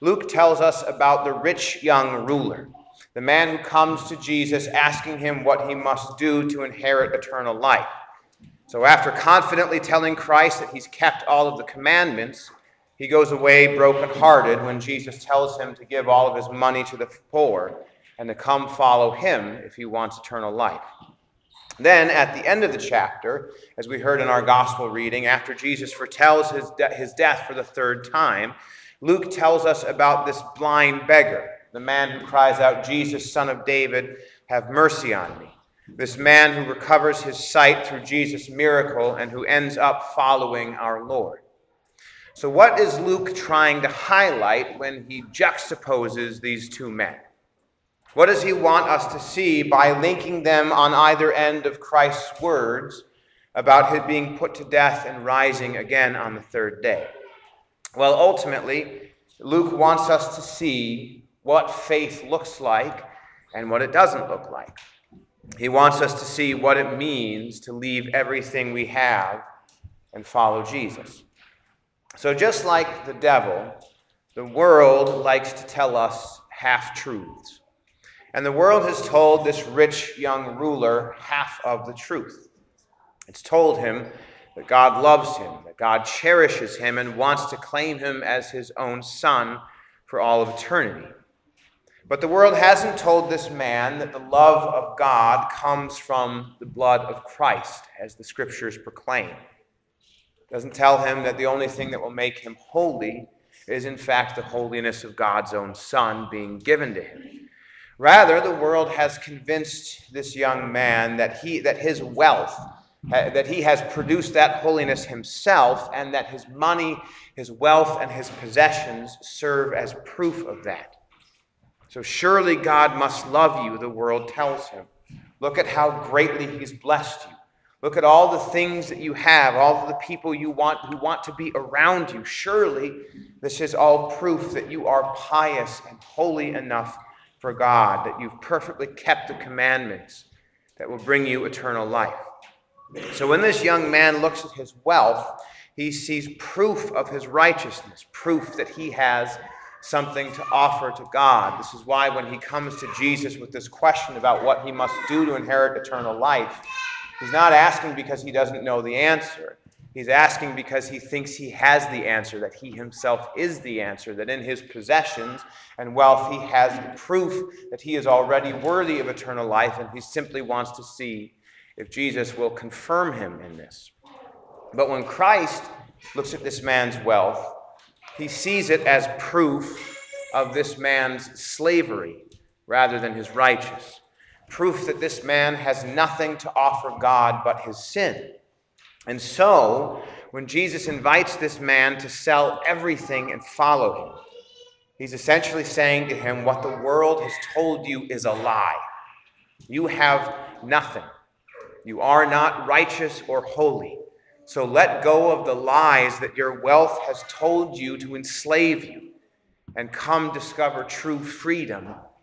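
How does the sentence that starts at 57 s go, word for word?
Well, ultimately, Luke wants us to see what faith looks like and what it doesn't look like.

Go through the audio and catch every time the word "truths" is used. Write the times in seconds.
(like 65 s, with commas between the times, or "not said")
76 s, 81 s.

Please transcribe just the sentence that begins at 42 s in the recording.
So, what is Luke trying to highlight when he juxtaposes these two men?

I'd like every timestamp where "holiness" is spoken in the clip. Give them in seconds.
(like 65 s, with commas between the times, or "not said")
104 s, 114 s.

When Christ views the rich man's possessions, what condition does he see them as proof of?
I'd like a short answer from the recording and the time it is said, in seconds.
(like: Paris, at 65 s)
Slavery, at 181 s.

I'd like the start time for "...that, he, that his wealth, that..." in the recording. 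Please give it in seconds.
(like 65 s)
111 s.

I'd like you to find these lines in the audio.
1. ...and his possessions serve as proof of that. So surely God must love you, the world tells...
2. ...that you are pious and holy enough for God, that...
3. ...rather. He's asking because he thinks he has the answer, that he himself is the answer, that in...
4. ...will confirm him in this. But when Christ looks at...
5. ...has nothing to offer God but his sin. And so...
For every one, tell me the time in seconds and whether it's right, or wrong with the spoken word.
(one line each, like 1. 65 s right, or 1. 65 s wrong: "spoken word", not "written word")
1. 118 s right
2. 134 s right
3. 158 s wrong: "answer", not "rather"
4. 172 s right
5. 185 s right.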